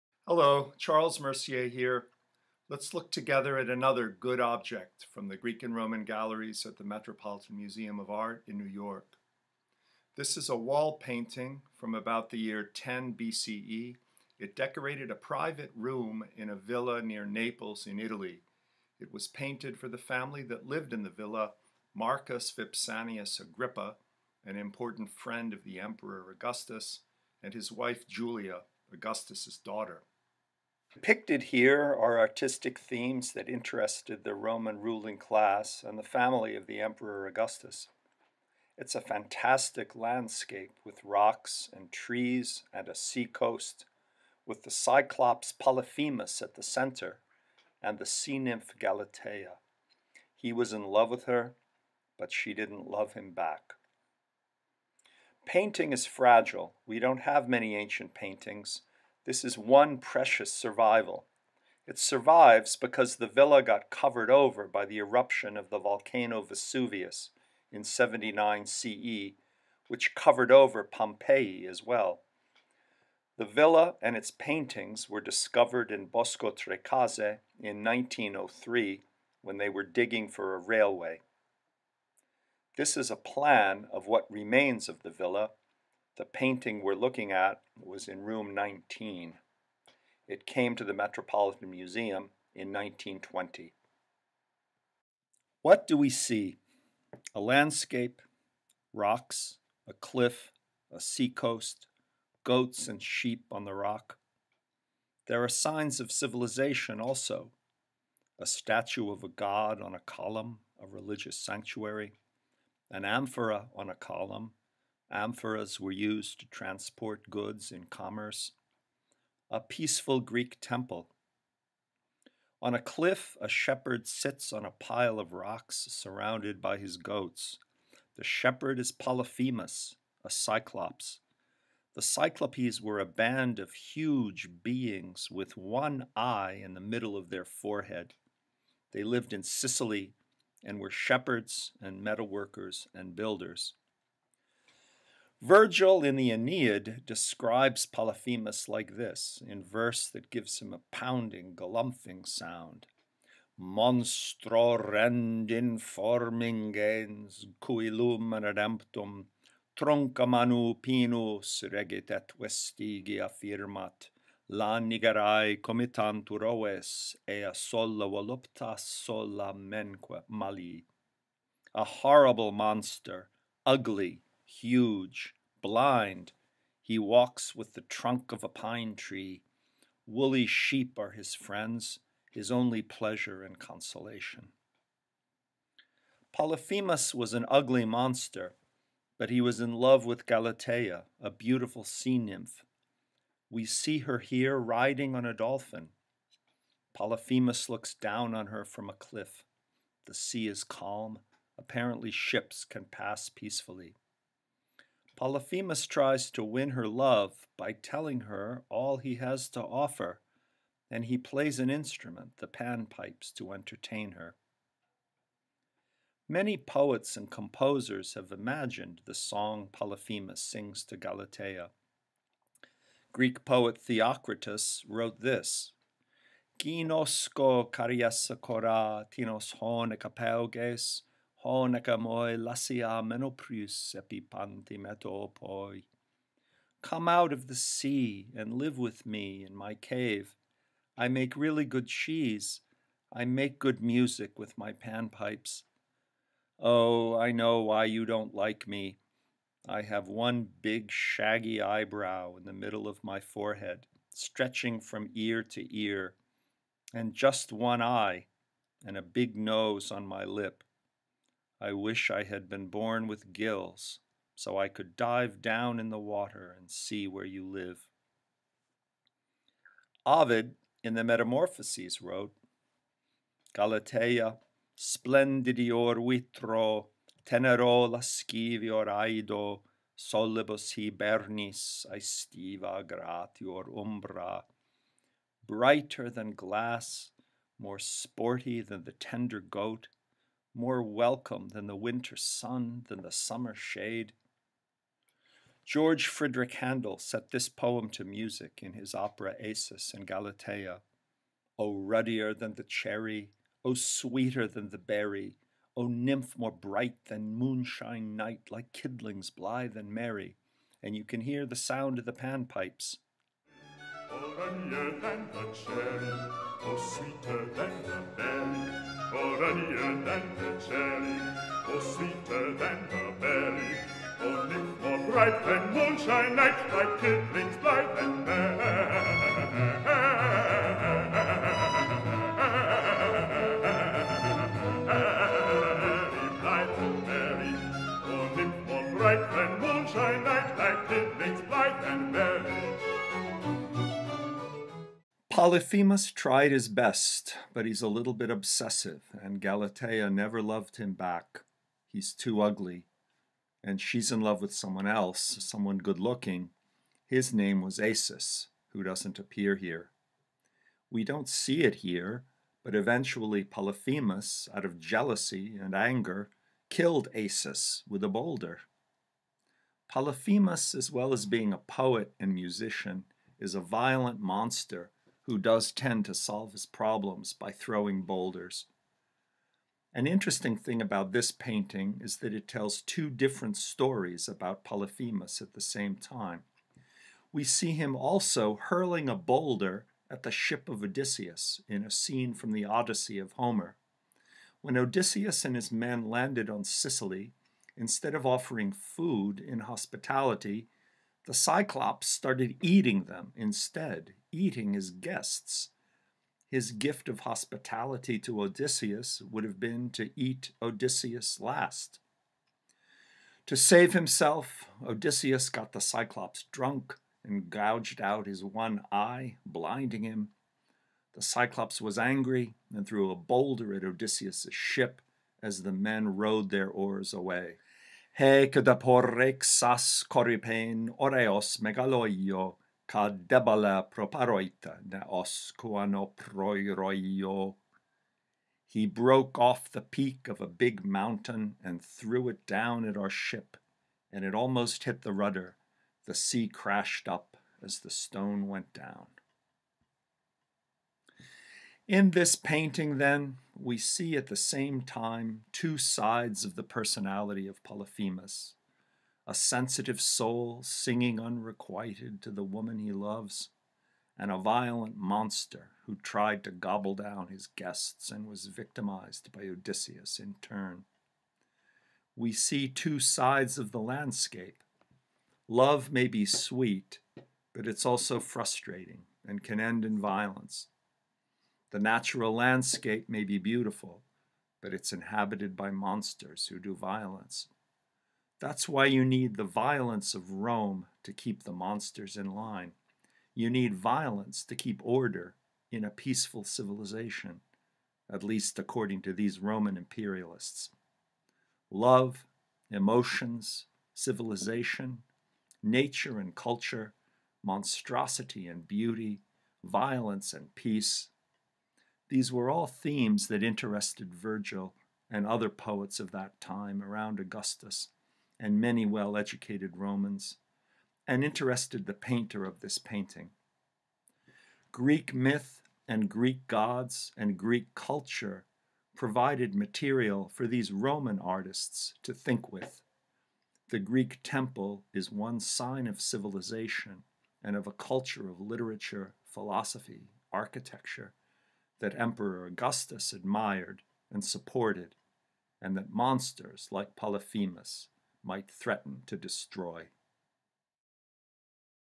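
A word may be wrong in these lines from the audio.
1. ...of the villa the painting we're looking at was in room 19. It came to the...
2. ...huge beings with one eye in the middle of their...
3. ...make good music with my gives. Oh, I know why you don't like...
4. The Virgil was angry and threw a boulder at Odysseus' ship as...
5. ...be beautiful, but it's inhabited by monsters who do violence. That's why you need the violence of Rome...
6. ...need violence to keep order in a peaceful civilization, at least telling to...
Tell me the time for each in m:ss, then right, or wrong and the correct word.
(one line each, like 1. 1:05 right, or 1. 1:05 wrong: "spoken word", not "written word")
1. 1:24 right
2. 2:13 right
3. 4:03 wrong: "panpipes", not "gives"
4. 7:01 wrong: "Cyclops", not "Virgil"
5. 8:03 right
6. 8:13 wrong: "according", not "telling".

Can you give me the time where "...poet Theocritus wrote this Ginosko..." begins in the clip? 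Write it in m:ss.
3:43.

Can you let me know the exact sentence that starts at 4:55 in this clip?
George Frideric Handel set this poem to music in his opera Acis and Galatea.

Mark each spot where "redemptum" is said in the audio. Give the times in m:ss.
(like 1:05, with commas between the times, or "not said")
2:38.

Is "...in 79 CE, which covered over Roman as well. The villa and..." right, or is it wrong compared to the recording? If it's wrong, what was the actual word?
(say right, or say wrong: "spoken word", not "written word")
wrong: "Pompeii", not "Roman".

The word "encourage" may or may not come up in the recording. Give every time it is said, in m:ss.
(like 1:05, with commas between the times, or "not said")
not said.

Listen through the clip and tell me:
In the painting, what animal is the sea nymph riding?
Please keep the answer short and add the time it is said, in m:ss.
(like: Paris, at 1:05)
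A dolphin, at 3:15.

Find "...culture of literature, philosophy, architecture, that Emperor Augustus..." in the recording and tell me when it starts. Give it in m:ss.
8:57.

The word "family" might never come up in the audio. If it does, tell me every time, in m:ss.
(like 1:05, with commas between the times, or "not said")
0:19, 0:36.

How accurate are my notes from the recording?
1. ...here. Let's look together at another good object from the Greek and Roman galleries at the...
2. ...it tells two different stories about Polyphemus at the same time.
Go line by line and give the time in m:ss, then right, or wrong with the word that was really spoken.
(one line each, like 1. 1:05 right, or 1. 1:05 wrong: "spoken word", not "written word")
1. 0:01 right
2. 6:22 right.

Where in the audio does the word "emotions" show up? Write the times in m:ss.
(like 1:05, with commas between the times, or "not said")
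8:22.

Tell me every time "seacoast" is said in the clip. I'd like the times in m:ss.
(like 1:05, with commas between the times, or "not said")
0:42, 1:40.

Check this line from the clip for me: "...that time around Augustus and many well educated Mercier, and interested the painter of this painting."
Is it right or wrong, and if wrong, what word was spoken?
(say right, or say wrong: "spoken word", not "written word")
wrong: "Romans", not "Mercier".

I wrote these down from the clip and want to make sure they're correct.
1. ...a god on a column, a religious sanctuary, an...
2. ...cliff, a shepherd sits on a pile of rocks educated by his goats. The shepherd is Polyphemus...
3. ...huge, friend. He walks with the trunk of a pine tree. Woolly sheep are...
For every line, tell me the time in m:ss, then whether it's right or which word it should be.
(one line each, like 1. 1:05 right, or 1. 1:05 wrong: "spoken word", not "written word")
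1. 1:49 right
2. 2:02 wrong: "surrounded", not "educated"
3. 2:54 wrong: "blind", not "friend".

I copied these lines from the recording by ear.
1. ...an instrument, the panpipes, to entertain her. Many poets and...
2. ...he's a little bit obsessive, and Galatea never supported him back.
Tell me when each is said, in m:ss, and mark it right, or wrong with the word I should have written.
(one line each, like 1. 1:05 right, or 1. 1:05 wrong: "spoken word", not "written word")
1. 3:31 right
2. 5:47 wrong: "loved", not "supported".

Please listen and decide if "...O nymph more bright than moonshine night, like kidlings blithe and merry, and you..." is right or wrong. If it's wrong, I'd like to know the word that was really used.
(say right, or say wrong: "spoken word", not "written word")
right.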